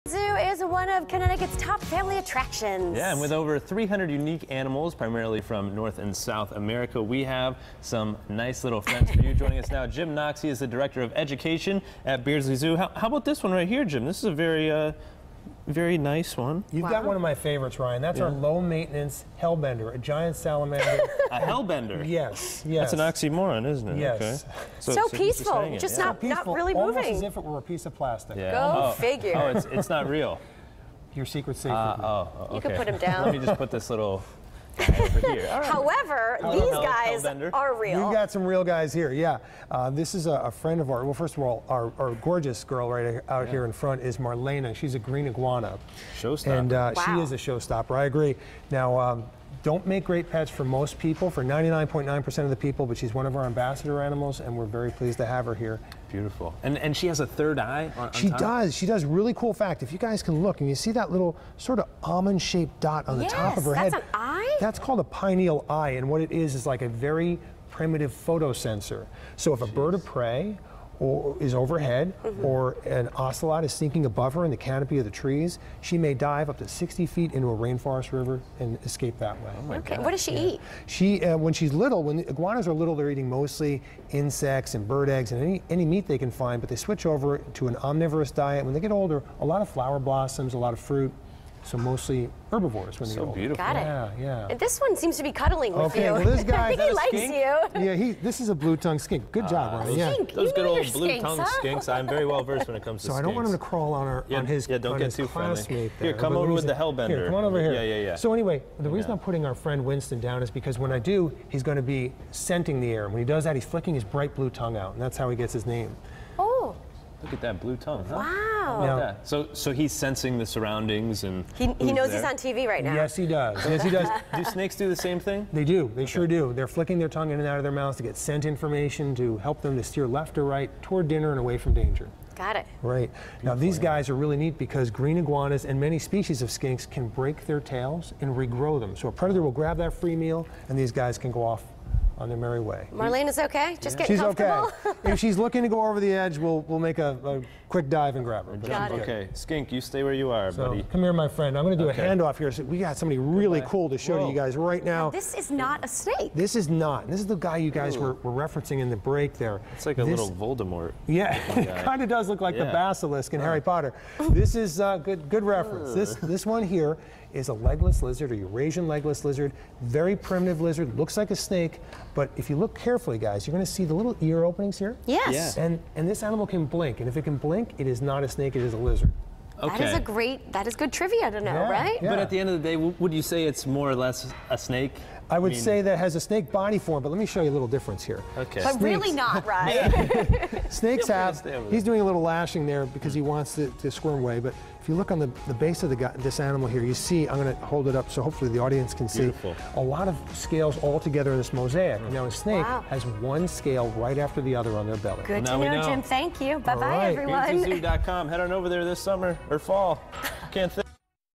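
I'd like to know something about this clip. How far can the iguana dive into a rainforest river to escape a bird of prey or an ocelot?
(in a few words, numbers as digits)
60 feet.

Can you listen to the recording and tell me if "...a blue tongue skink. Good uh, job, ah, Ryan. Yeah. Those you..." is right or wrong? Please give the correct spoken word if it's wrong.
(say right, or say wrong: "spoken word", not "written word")
right.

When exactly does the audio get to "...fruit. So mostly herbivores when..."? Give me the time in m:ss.
1:30.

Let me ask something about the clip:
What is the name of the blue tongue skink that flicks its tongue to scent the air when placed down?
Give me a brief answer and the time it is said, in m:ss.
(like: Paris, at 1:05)
Winston, at 1:49.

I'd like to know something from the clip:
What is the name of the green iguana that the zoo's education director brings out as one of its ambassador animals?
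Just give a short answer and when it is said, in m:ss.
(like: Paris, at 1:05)
Marlena, at 0:44.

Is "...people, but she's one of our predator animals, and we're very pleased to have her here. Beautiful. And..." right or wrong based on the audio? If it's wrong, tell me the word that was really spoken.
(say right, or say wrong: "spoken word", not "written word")
wrong: "ambassador", not "predator".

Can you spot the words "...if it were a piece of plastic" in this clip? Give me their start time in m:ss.
0:27.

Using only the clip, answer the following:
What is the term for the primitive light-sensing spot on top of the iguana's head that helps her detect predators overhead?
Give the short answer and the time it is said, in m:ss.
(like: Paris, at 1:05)
pineal eye, at 1:05.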